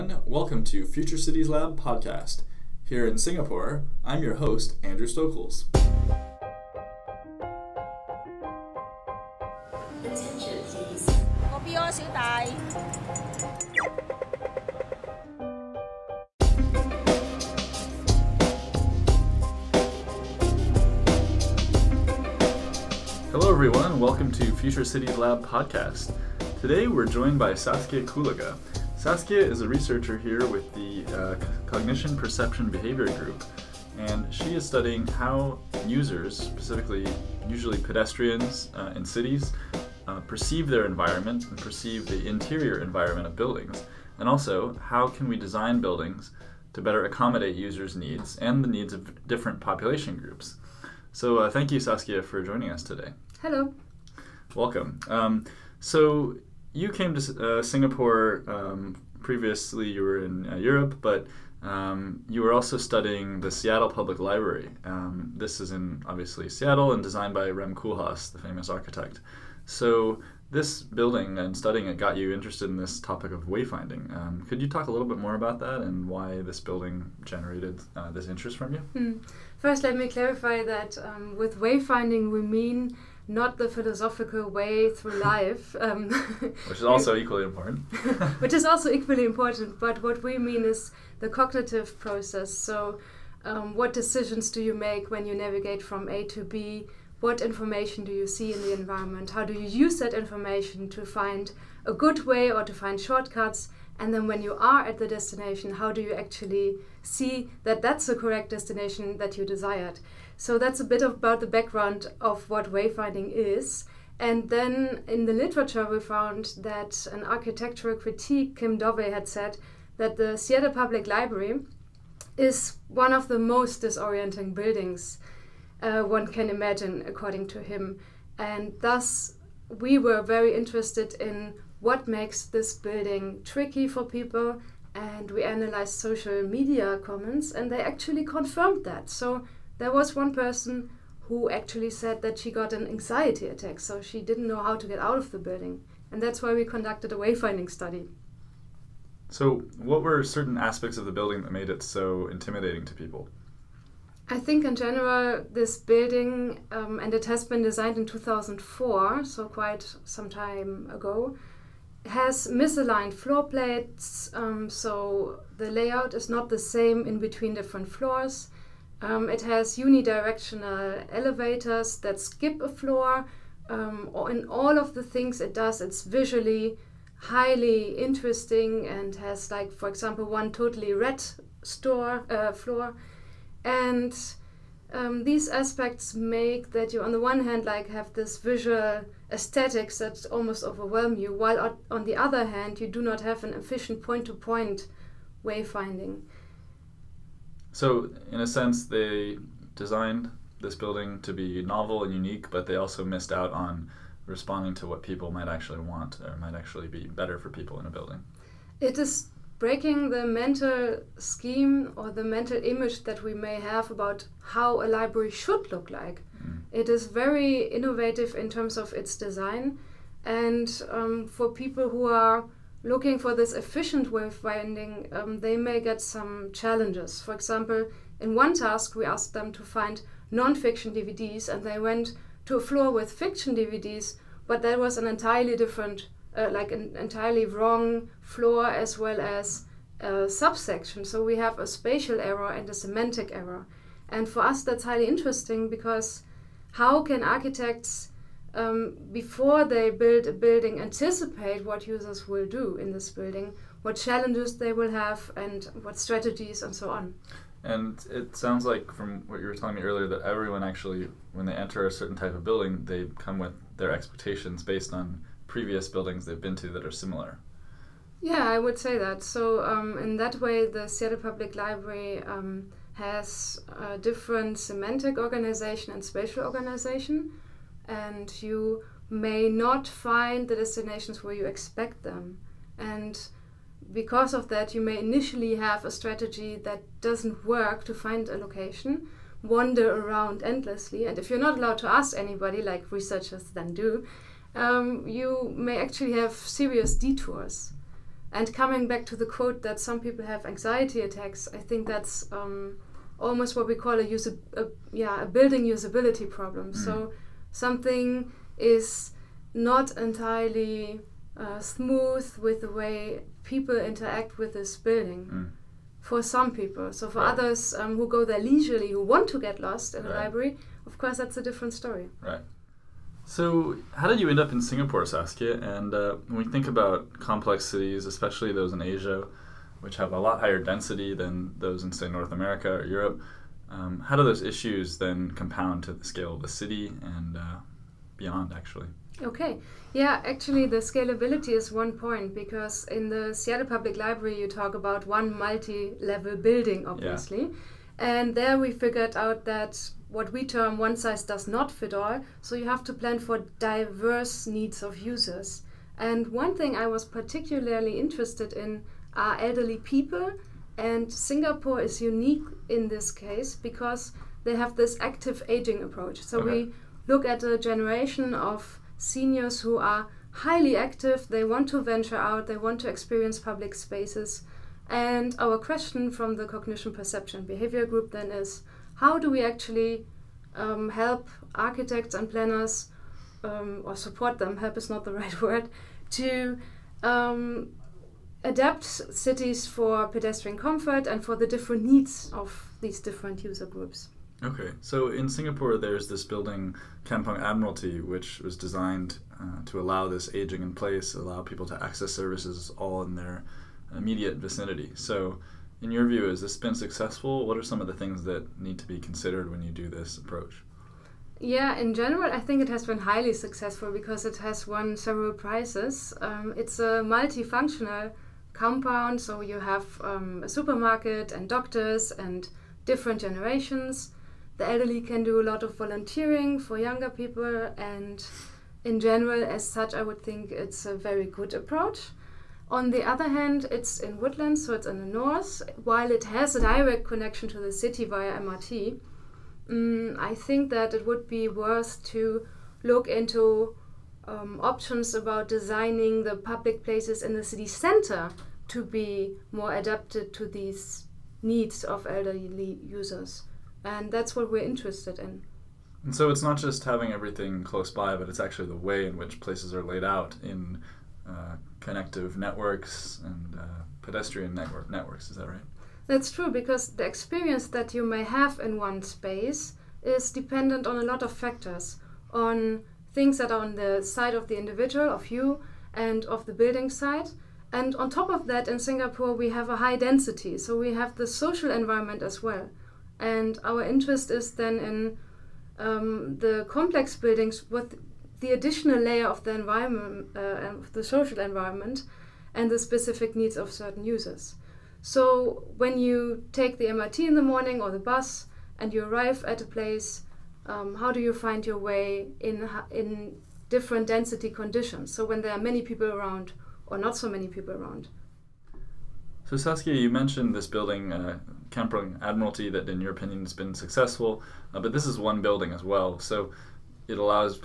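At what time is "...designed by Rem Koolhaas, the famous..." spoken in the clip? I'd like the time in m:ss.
1:07.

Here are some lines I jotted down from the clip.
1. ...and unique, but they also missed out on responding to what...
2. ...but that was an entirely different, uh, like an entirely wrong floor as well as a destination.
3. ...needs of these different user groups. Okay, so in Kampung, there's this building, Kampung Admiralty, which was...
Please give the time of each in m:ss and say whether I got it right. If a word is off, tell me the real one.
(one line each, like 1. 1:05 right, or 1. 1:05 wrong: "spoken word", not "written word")
1. 3:22 right
2. 3:54 wrong: "subsection", not "destination"
3. 6:31 wrong: "Singapore", not "Kampung".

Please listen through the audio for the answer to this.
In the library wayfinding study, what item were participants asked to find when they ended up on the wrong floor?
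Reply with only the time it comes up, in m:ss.
3:50.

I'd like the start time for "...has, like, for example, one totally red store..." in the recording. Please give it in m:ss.
2:59.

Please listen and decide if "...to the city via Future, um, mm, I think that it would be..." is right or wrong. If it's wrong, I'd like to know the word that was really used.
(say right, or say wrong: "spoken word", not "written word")
wrong: "MRT", not "Future".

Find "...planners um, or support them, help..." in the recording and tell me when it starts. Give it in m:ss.
6:22.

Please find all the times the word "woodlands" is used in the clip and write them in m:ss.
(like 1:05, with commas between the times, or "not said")
7:14.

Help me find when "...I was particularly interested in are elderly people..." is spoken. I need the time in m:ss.
5:56.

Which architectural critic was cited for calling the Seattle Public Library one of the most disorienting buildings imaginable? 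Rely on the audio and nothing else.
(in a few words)
Kim Dovey.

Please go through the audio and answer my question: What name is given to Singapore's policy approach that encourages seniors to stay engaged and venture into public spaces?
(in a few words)
Active aging.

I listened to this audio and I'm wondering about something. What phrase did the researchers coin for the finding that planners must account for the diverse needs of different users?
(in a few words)
One size does not fit all.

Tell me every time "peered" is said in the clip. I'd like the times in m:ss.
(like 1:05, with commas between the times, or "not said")
not said.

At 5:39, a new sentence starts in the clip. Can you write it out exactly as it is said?
Okay, yeah, actually, the scalability is one point because in the Seattle Public Library, you talk about one multi level building, obviously.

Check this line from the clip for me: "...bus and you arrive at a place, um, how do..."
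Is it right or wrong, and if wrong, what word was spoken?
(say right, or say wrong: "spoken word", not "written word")
right.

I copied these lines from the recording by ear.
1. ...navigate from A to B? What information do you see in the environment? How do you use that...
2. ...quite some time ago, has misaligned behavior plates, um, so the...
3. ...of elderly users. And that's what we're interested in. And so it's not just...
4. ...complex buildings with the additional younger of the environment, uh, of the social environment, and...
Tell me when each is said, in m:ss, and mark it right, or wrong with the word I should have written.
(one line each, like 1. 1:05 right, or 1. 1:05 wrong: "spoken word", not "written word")
1. 1:35 right
2. 2:39 wrong: "floor", not "behavior"
3. 7:31 right
4. 8:06 wrong: "layer", not "younger".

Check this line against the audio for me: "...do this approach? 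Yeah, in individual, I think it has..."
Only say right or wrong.
wrong.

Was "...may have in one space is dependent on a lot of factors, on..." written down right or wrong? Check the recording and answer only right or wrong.
right.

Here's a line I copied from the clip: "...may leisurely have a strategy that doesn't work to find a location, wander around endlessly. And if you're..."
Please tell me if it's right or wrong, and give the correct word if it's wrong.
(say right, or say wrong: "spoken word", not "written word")
wrong: "initially", not "leisurely".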